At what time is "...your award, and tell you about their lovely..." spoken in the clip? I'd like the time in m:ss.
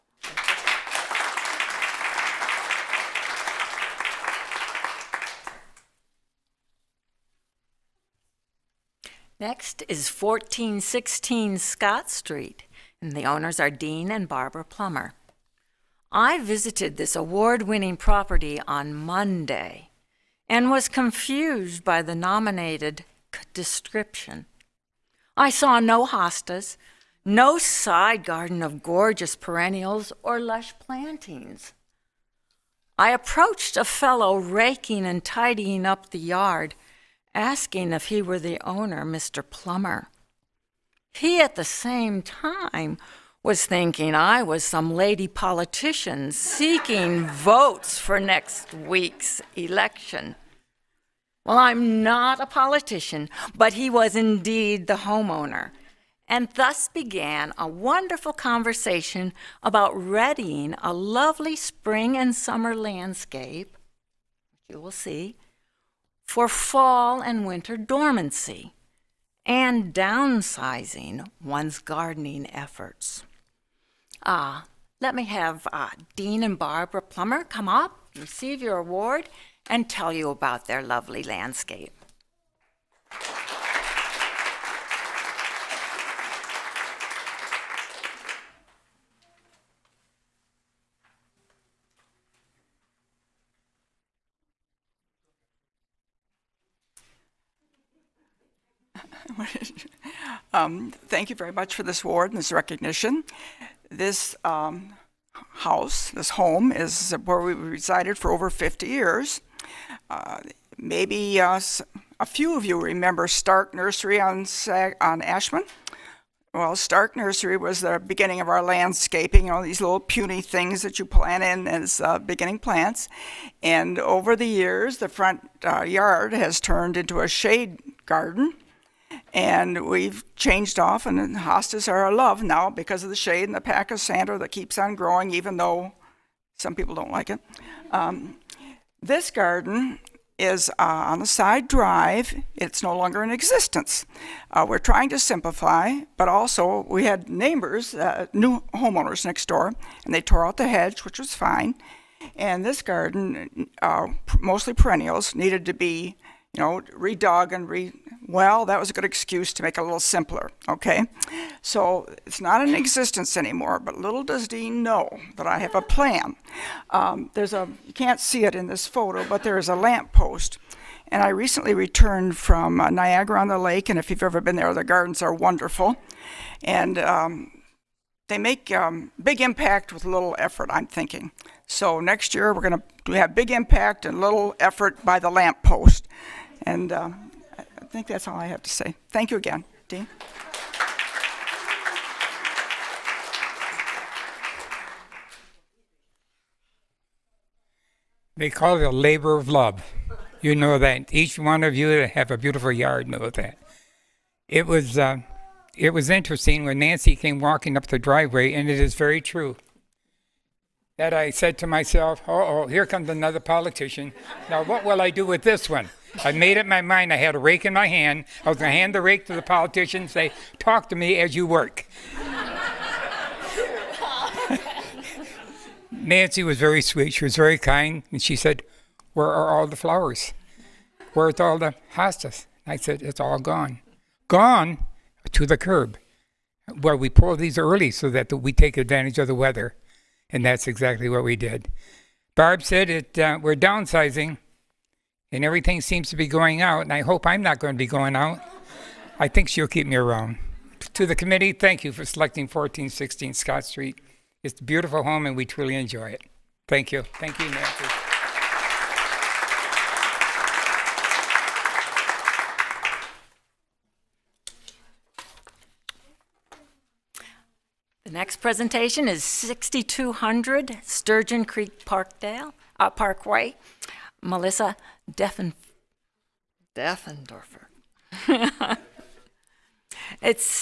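1:18.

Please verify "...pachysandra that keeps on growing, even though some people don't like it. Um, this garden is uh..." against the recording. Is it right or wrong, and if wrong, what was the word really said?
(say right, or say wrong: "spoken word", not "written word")
right.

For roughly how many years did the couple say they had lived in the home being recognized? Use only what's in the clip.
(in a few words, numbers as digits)
over 50 years.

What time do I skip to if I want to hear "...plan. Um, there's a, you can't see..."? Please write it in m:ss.
2:45.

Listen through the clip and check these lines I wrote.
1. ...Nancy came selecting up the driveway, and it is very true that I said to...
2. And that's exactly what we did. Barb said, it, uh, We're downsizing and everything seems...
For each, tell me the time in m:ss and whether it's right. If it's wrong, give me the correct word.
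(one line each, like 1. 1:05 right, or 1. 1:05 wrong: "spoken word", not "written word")
1. 3:26 wrong: "walking", not "selecting"
2. 4:00 right.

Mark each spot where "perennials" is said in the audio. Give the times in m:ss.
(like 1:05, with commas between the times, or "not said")
0:29, 2:34.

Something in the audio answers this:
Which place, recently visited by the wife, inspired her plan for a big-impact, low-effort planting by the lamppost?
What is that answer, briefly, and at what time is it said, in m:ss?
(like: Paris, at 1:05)
Niagara on the Lake, at 2:52.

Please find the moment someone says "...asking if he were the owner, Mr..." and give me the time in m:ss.
0:37.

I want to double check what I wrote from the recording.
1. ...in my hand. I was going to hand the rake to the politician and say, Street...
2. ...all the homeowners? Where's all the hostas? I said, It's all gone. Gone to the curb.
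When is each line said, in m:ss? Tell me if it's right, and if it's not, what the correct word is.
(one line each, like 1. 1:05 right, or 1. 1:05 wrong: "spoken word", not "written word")
1. 3:37 wrong: "Talk", not "Street"
2. 3:49 wrong: "flowers", not "homeowners".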